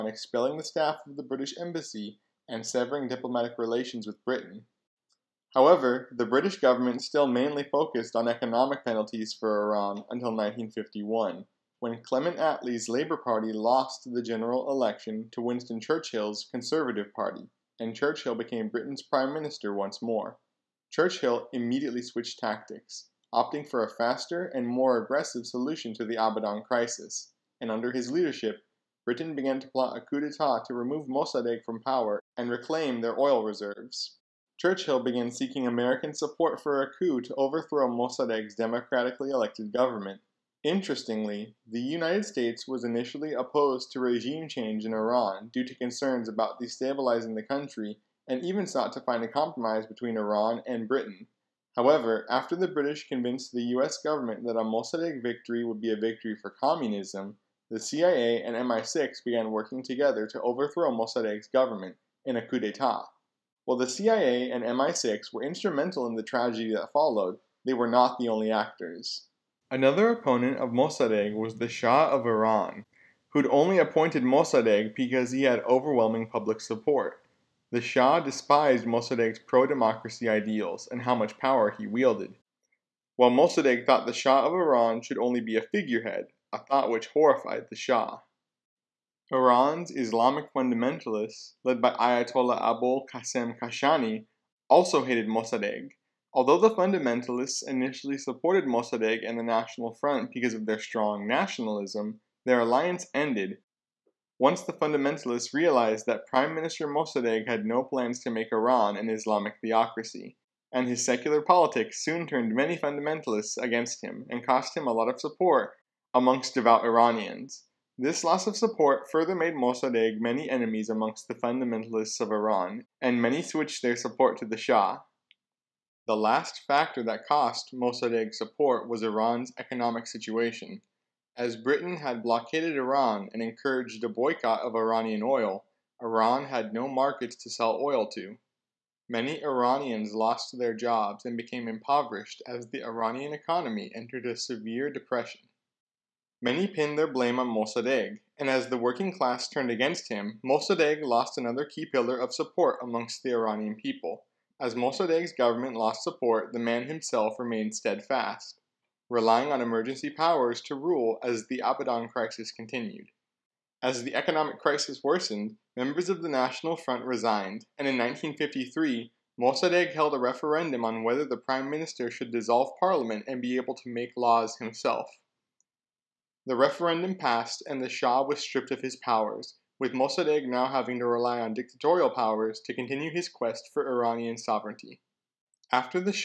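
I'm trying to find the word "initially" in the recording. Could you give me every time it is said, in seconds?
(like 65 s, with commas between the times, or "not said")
42 s, 97 s.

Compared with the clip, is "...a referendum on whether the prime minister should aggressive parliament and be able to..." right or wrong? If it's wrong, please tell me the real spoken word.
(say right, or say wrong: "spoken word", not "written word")
wrong: "dissolve", not "aggressive".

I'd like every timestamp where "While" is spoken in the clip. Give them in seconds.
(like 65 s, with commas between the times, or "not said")
63 s, 83 s.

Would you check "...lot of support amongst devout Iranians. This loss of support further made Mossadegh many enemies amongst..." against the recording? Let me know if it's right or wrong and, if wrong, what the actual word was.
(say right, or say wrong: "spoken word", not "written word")
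right.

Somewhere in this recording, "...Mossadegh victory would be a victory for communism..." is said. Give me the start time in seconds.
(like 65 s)
54 s.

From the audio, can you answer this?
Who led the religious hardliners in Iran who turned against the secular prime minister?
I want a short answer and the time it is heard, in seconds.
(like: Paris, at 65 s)
Ayatollah Abul Qasem Kashani, at 91 s.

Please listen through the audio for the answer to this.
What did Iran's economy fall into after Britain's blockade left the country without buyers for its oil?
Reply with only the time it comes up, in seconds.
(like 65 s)
144 s.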